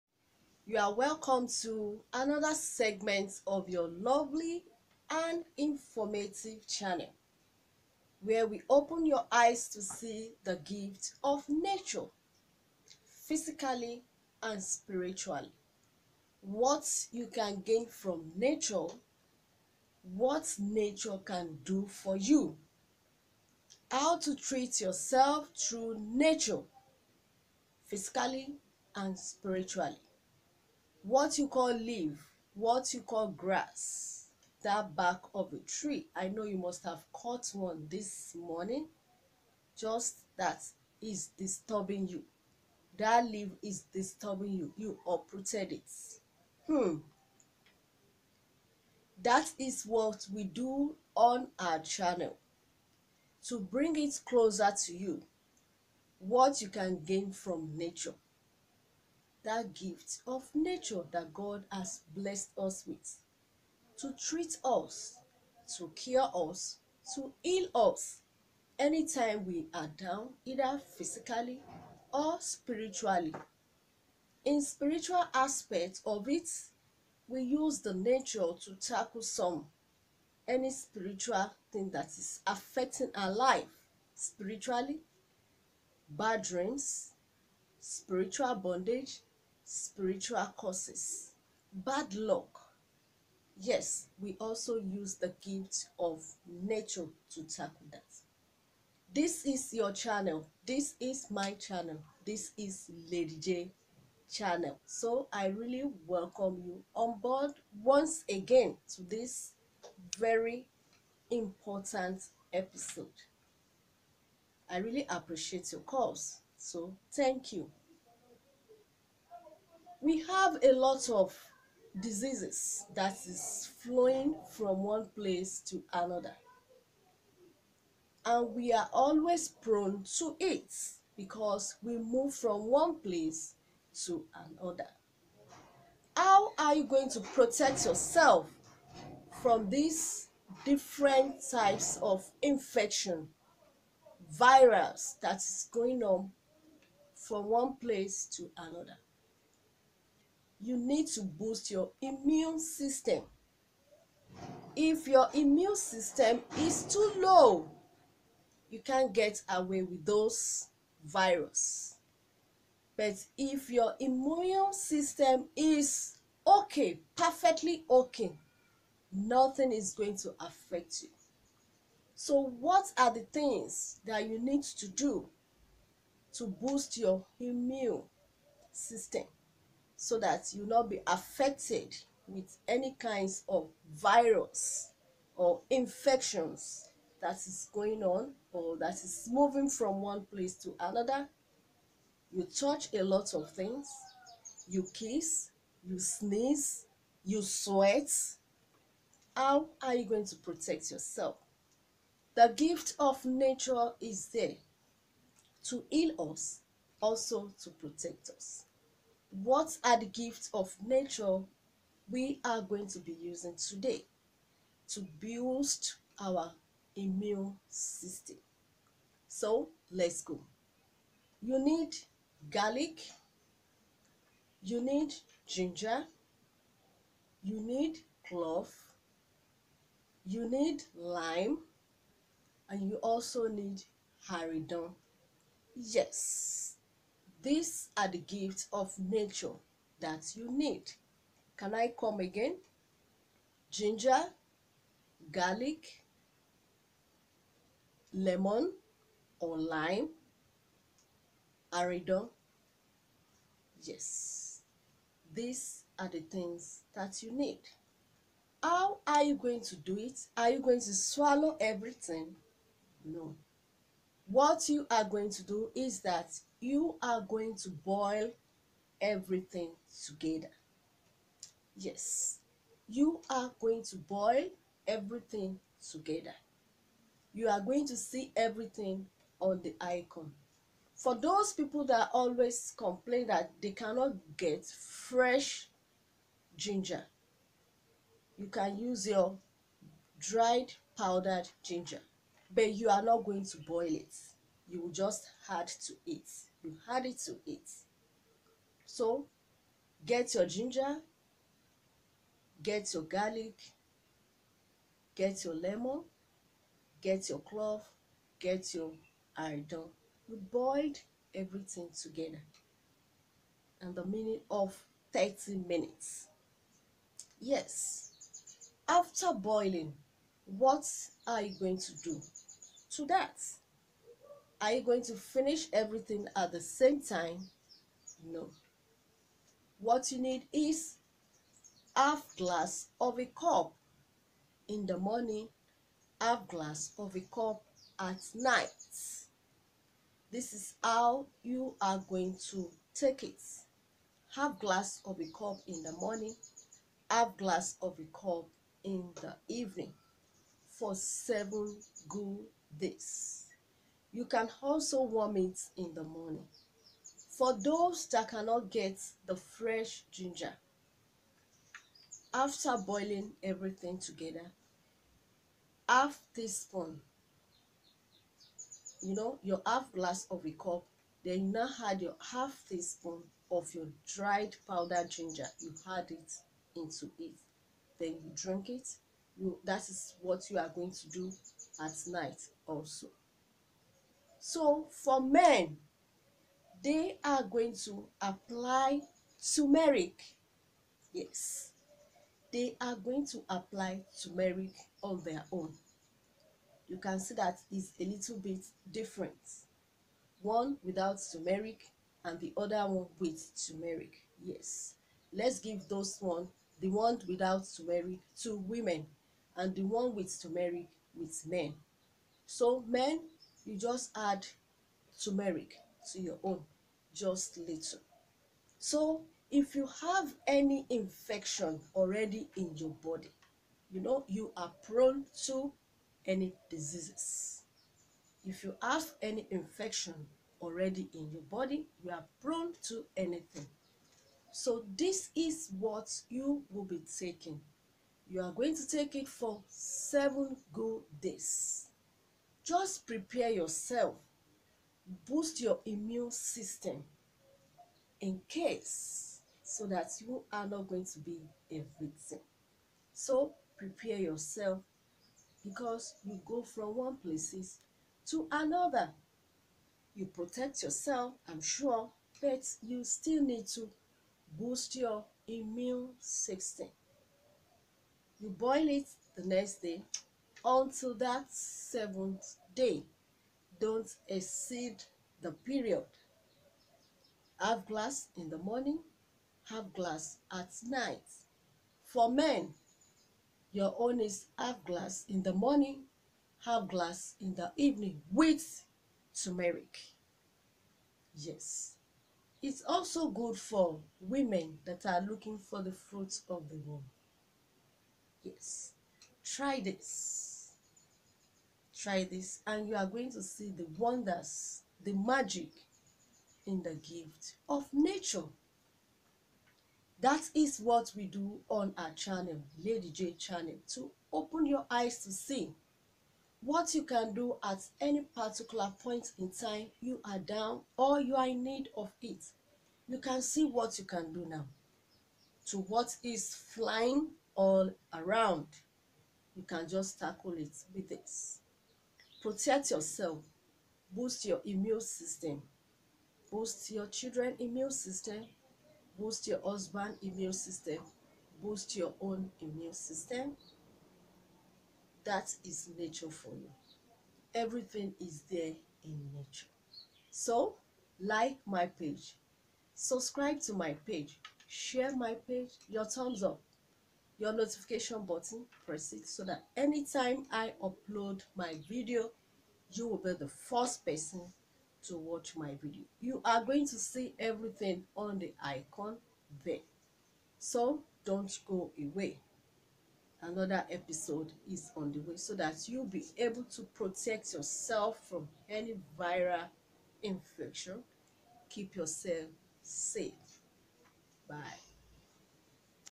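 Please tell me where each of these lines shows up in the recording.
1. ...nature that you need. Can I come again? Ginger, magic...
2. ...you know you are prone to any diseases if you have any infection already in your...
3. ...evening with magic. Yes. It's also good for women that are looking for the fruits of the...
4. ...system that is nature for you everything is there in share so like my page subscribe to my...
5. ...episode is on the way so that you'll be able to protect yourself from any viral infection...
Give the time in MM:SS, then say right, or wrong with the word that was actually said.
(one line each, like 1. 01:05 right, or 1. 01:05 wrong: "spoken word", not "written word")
1. 03:58 wrong: "garlic", not "magic"
2. 07:03 right
3. 08:07 wrong: "turmeric", not "magic"
4. 09:02 wrong: "nature", not "share"
5. 09:33 right.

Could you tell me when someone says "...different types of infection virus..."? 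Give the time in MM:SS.
02:20.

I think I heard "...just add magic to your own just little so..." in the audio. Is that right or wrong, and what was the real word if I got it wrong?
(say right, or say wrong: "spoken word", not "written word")
wrong: "turmeric", not "magic".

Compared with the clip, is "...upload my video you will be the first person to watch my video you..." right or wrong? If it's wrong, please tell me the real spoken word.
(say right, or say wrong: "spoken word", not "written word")
right.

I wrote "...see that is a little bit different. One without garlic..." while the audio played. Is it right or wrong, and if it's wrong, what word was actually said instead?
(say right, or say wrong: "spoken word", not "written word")
wrong: "turmeric", not "garlic".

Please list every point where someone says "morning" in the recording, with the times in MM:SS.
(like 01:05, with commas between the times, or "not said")
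00:38, 05:34, 05:45, 05:56, 07:58, 08:05.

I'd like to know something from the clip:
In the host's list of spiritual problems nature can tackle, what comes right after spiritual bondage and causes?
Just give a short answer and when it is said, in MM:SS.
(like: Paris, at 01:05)
bad luck, at 01:31.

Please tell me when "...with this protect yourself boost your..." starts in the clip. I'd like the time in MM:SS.
08:50.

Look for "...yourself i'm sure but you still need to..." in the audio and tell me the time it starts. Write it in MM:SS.
07:40.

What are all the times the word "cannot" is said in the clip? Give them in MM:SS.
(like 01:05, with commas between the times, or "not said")
04:43, 05:58.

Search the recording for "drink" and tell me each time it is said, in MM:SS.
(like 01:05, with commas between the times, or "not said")
06:18.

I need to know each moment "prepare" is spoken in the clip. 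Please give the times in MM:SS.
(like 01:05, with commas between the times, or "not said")
07:23, 07:33.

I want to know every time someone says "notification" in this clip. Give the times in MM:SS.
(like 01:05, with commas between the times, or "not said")
09:17.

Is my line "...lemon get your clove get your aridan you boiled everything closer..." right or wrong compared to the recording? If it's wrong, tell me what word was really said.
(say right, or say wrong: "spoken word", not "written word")
wrong: "together", not "closer".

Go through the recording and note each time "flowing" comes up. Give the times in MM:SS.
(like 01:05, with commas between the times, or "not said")
02:03.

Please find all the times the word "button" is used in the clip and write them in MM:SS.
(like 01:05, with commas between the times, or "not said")
09:18.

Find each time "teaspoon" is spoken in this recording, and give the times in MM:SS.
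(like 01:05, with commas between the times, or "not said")
06:06, 06:12.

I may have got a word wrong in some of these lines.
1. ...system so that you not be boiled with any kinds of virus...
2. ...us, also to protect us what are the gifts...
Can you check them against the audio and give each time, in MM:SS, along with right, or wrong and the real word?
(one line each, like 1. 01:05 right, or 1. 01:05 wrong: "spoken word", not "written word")
1. 02:58 wrong: "affected", not "boiled"
2. 03:26 right.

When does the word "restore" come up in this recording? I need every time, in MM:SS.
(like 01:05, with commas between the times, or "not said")
not said.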